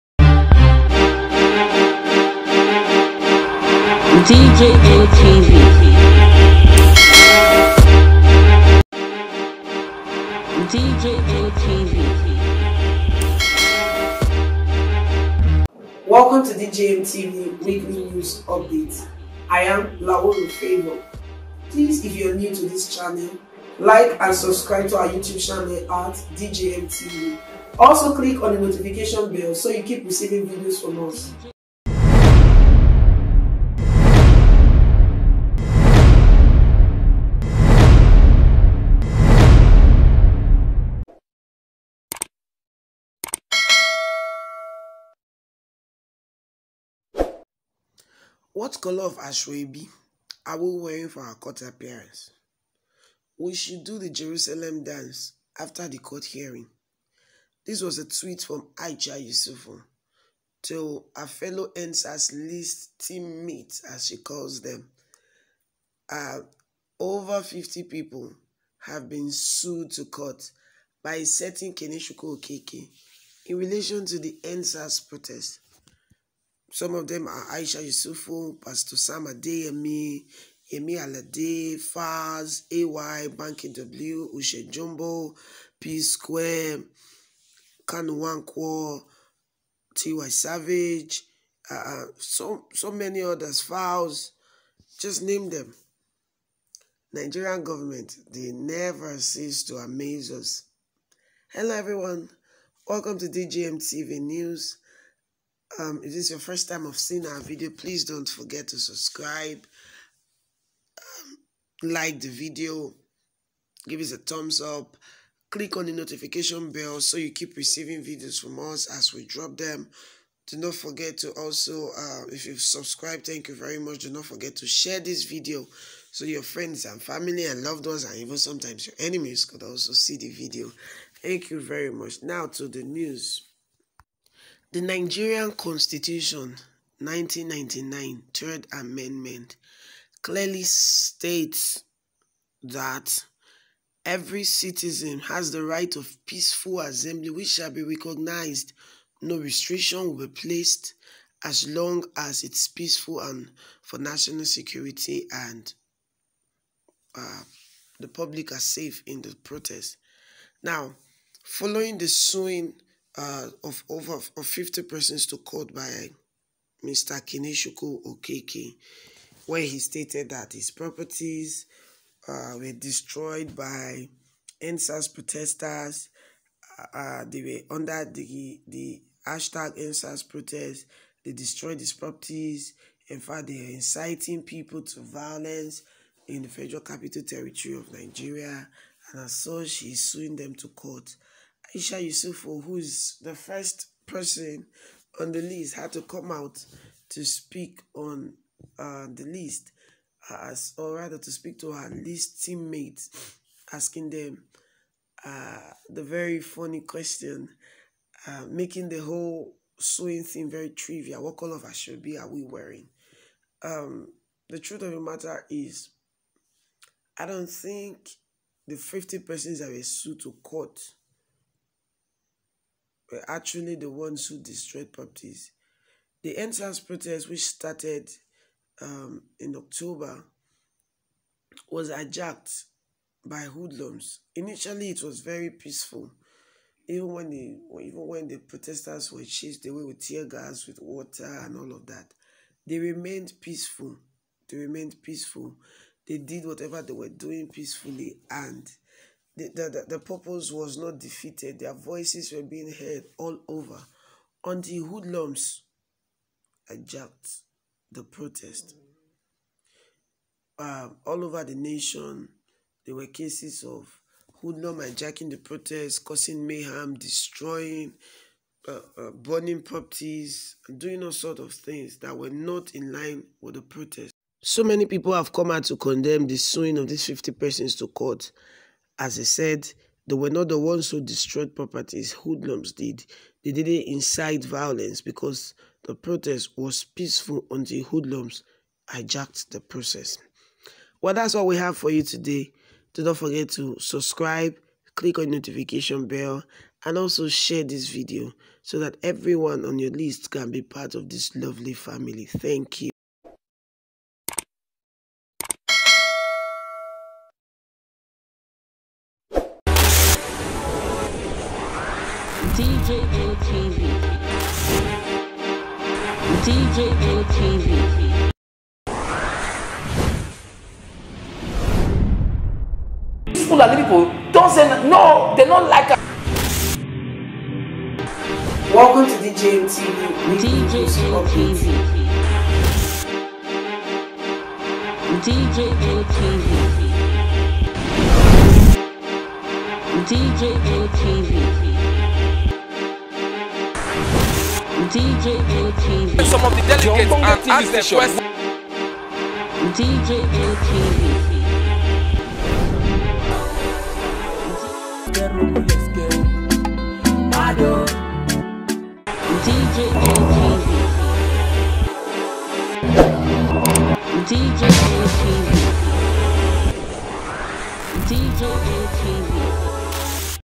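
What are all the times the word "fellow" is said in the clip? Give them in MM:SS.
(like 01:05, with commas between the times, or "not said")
01:01.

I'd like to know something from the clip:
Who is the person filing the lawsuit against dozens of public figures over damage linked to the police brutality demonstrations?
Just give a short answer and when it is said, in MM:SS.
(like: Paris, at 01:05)
Keneshuko Okeke, at 01:11.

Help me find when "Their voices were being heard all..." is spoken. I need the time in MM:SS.
04:11.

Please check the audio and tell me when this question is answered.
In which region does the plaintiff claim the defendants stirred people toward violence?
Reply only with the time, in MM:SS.
03:06.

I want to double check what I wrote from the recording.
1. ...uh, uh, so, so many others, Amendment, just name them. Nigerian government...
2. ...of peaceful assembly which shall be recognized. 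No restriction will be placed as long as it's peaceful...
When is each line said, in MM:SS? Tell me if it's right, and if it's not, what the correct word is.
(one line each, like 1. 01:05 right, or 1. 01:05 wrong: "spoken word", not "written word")
1. 01:31 wrong: "Files", not "Amendment"
2. 02:25 right.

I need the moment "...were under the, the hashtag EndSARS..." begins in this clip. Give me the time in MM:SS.
02:57.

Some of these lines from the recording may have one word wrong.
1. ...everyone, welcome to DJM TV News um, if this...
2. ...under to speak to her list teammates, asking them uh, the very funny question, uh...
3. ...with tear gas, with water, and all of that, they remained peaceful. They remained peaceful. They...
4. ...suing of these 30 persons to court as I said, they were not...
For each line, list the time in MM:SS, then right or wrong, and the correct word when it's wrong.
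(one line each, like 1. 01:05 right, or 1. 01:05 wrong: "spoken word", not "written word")
1. 01:41 right
2. 03:20 wrong: "rather", not "under"
3. 03:59 right
4. 04:36 wrong: "50", not "30".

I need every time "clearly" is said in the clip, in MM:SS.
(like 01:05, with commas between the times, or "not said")
02:20.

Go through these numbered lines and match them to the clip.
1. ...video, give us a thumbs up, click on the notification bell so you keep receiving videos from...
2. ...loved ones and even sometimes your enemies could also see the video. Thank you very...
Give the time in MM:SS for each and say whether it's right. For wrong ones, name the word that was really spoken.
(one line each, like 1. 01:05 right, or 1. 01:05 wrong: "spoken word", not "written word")
1. 01:52 right
2. 02:07 right.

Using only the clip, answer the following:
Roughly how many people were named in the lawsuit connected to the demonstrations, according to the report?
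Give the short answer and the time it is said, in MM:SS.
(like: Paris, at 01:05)
over 50, at 01:06.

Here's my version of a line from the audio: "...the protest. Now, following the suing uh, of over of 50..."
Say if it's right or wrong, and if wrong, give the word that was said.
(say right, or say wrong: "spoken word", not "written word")
right.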